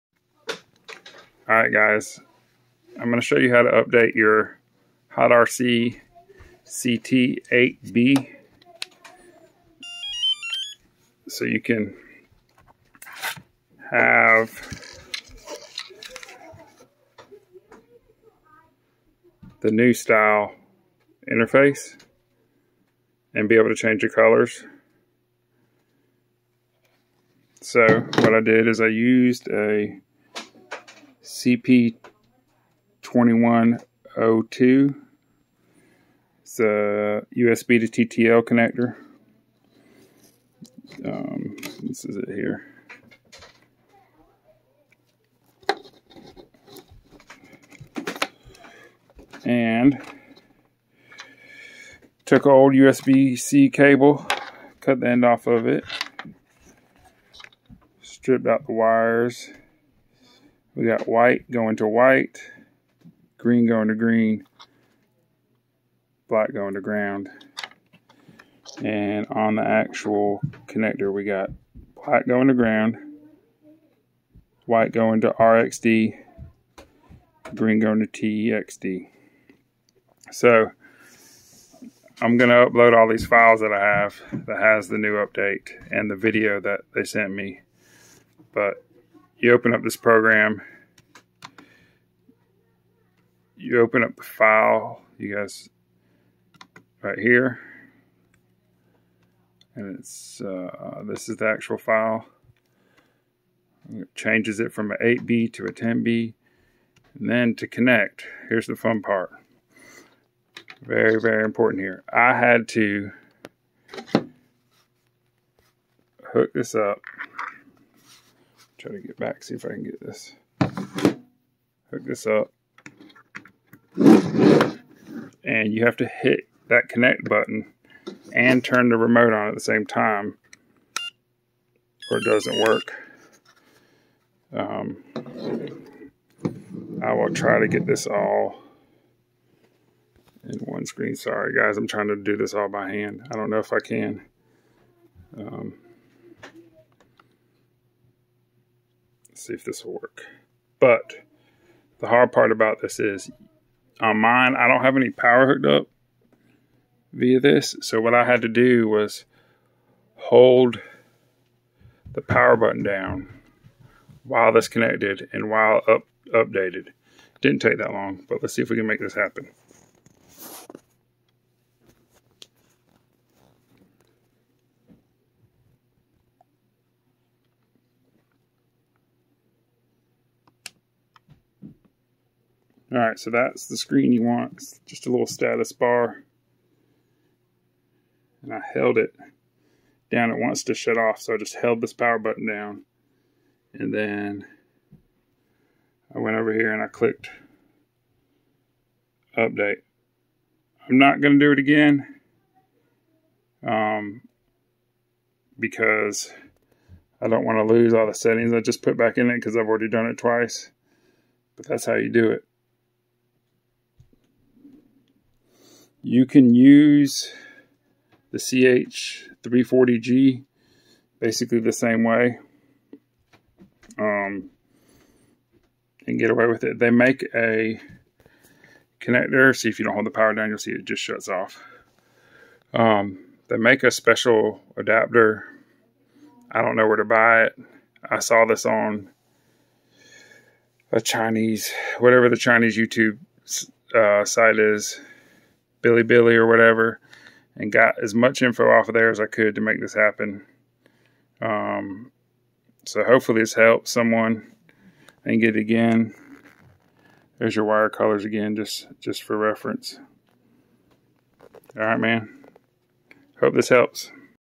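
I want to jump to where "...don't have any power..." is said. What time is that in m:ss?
2:34.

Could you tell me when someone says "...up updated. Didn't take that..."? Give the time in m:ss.
2:45.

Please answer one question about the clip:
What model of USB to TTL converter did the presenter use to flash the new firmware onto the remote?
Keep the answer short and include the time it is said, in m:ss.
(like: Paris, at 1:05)
CP2102, at 0:31.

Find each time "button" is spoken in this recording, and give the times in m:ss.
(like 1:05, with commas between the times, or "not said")
2:07, 2:42, 3:12.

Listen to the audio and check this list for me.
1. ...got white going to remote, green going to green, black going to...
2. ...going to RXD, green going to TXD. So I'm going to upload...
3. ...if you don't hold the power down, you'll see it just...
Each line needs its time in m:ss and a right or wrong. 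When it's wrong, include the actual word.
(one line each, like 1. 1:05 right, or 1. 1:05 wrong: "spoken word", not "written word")
1. 1:00 wrong: "white", not "remote"
2. 1:14 right
3. 3:49 right.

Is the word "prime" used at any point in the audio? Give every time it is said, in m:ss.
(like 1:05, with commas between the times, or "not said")
not said.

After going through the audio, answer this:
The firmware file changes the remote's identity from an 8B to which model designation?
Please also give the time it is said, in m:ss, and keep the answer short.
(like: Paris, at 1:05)
10B, at 1:45.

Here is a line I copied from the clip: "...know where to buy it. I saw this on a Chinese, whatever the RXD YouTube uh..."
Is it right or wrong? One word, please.
wrong.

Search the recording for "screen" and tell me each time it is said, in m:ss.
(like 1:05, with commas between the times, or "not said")
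2:20, 3:03.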